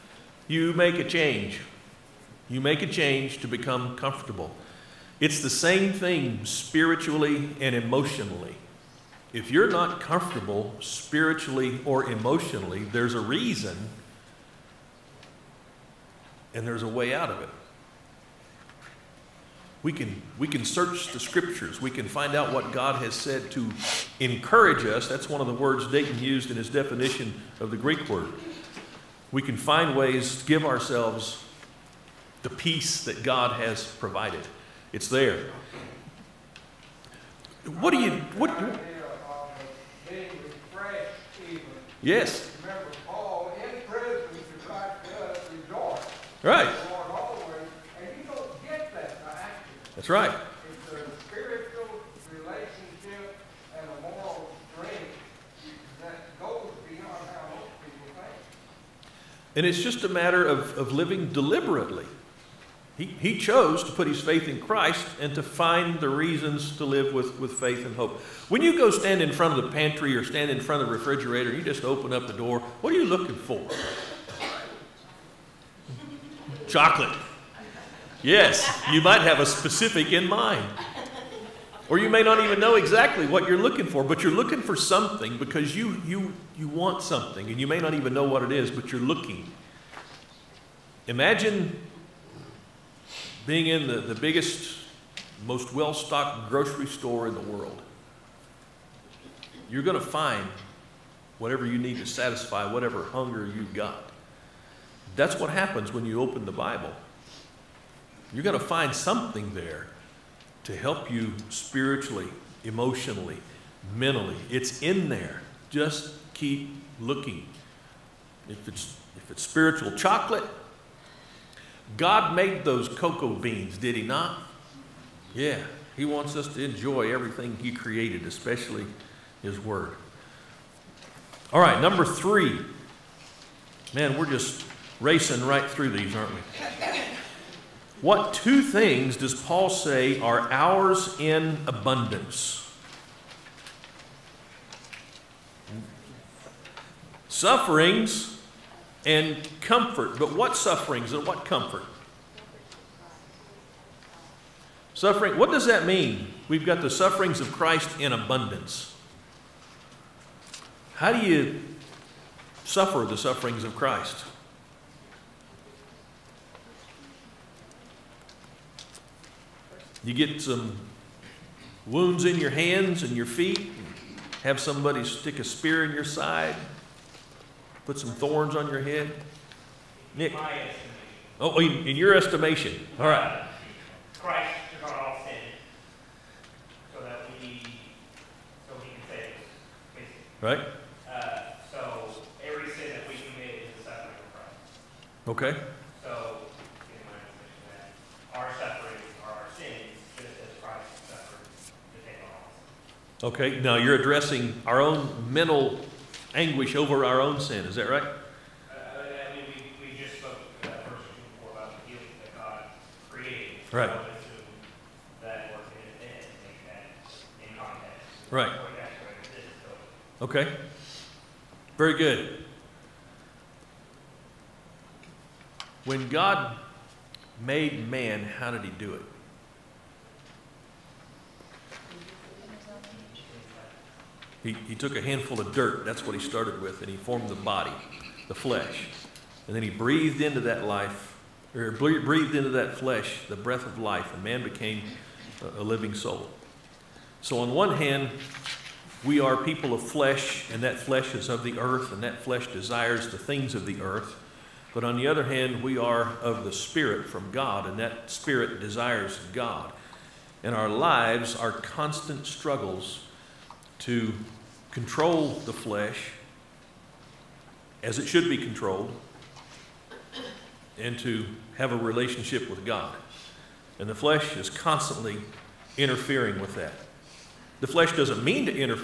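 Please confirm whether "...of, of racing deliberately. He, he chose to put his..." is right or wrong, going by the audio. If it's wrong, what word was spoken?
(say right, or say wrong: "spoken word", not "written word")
wrong: "living", not "racing".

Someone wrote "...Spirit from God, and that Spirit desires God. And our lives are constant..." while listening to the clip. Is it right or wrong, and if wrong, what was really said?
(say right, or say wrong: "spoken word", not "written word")
right.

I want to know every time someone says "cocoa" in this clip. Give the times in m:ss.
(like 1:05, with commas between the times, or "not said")
2:02.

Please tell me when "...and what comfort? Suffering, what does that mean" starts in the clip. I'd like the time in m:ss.
2:31.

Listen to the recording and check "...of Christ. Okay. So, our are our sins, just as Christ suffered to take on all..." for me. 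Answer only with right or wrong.
right.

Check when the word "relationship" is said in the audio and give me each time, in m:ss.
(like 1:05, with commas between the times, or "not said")
0:52, 4:31.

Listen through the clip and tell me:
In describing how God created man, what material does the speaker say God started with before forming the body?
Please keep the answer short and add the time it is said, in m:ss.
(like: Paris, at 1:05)
A handful of dirt, at 3:54.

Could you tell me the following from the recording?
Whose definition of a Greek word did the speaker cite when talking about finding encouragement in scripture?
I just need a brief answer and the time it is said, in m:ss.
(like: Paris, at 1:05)
Dayton, at 0:25.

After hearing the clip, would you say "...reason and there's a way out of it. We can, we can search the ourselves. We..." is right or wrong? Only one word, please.
wrong.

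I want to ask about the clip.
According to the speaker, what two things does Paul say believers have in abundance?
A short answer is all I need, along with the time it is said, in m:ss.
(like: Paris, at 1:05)
Sufferings and comfort, at 2:27.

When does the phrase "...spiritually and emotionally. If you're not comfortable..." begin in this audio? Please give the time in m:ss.
0:06.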